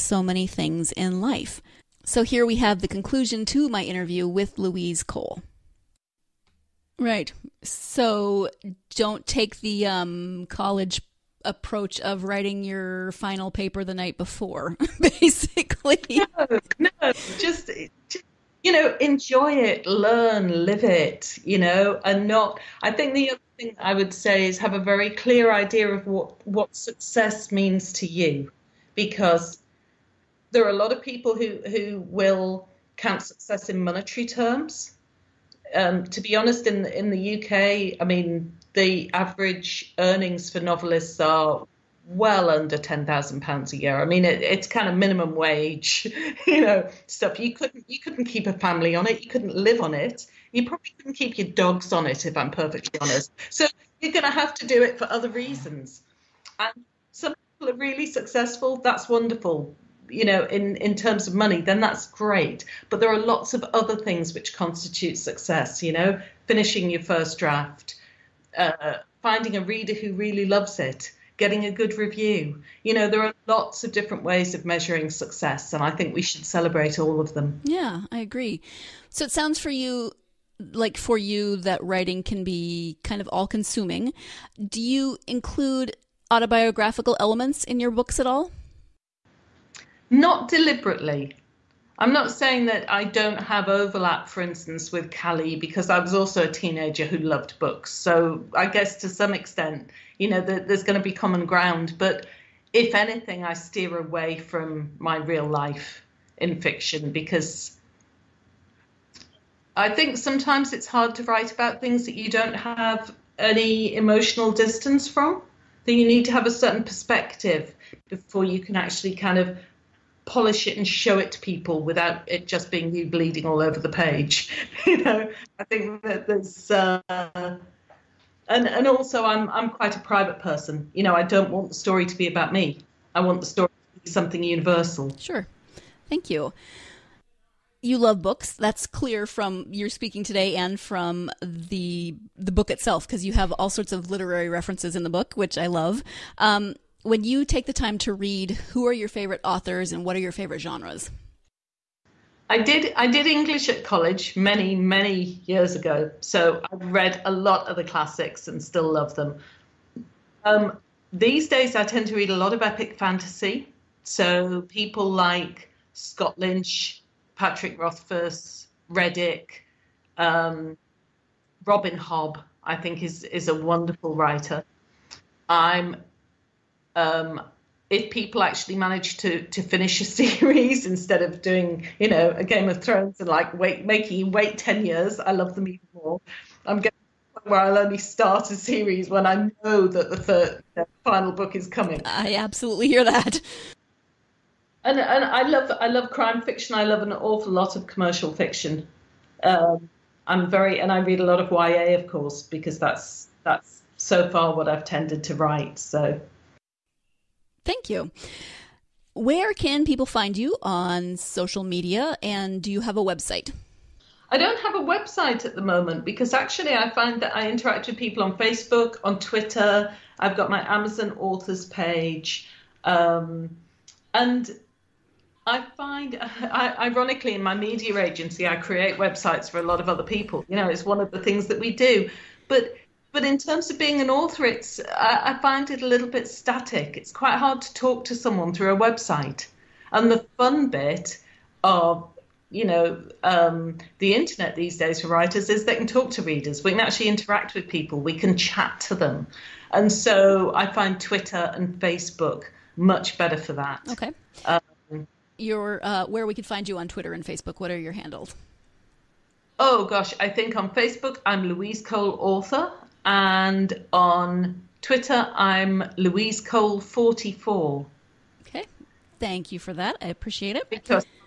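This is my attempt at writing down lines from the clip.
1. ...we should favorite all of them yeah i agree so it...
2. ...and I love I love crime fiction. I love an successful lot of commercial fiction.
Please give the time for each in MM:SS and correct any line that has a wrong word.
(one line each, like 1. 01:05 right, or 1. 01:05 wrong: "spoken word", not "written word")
1. 01:16 wrong: "celebrate", not "favorite"
2. 03:14 wrong: "awful", not "successful".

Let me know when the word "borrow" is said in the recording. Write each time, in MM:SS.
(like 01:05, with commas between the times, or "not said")
not said.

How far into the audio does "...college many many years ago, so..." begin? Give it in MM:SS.
02:33.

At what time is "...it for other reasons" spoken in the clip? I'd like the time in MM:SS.
00:54.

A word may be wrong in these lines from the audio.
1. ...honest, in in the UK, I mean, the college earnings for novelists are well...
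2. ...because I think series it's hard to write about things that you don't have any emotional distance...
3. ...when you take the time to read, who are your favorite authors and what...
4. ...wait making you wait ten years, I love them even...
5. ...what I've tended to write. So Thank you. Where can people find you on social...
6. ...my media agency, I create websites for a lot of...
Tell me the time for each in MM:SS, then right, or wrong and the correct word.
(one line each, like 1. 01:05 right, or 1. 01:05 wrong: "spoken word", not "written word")
1. 00:36 wrong: "average", not "college"
2. 01:47 wrong: "sometimes", not "series"
3. 02:27 right
4. 03:03 right
5. 03:24 right
6. 03:47 right.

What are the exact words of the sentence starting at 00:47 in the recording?
You couldn't you couldn't keep a family on it.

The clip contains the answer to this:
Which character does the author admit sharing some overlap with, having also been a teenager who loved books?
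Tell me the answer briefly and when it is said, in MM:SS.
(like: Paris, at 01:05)
Callie, at 01:35.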